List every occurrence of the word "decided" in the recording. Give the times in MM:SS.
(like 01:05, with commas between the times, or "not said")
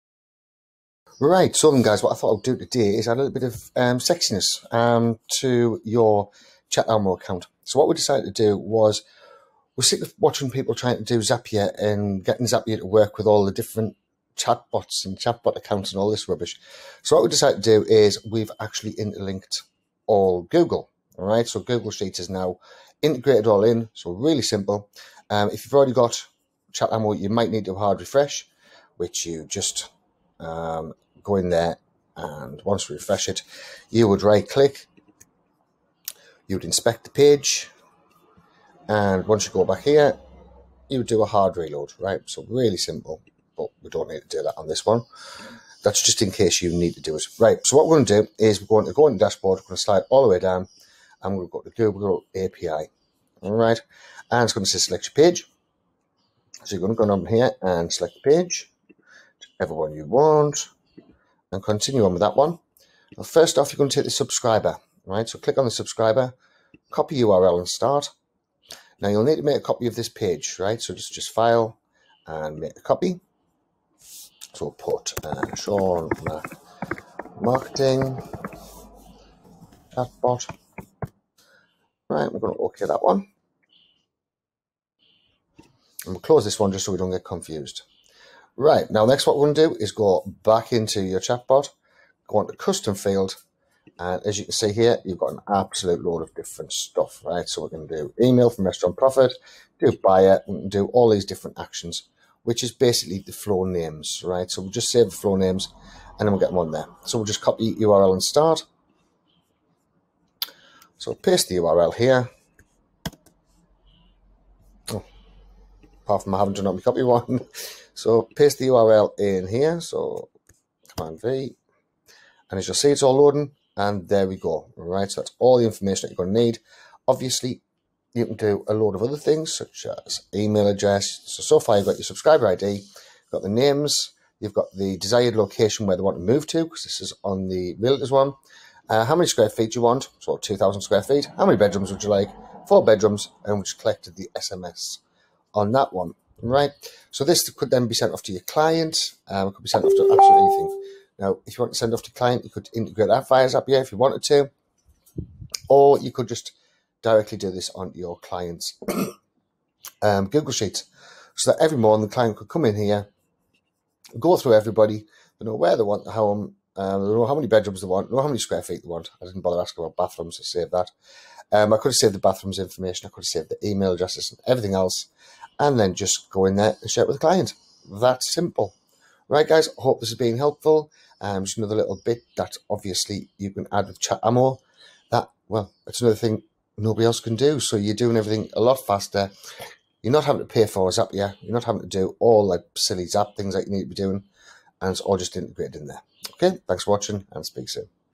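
00:07, 00:17.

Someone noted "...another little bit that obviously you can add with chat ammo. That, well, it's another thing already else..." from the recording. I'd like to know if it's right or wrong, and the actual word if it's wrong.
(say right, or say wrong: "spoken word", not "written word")
wrong: "nobody", not "already".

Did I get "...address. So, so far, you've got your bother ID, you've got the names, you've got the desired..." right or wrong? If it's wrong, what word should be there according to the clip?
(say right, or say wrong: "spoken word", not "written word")
wrong: "subscriber", not "bother".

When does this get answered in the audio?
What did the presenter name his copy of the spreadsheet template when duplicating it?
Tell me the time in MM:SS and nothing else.
01:15.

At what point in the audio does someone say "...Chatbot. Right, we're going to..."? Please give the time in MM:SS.
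01:19.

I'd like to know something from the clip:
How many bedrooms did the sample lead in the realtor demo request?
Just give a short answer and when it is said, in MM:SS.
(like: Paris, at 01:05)
4, at 02:22.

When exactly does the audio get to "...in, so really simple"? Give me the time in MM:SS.
00:23.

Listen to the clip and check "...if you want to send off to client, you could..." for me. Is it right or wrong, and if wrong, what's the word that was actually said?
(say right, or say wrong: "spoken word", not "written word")
right.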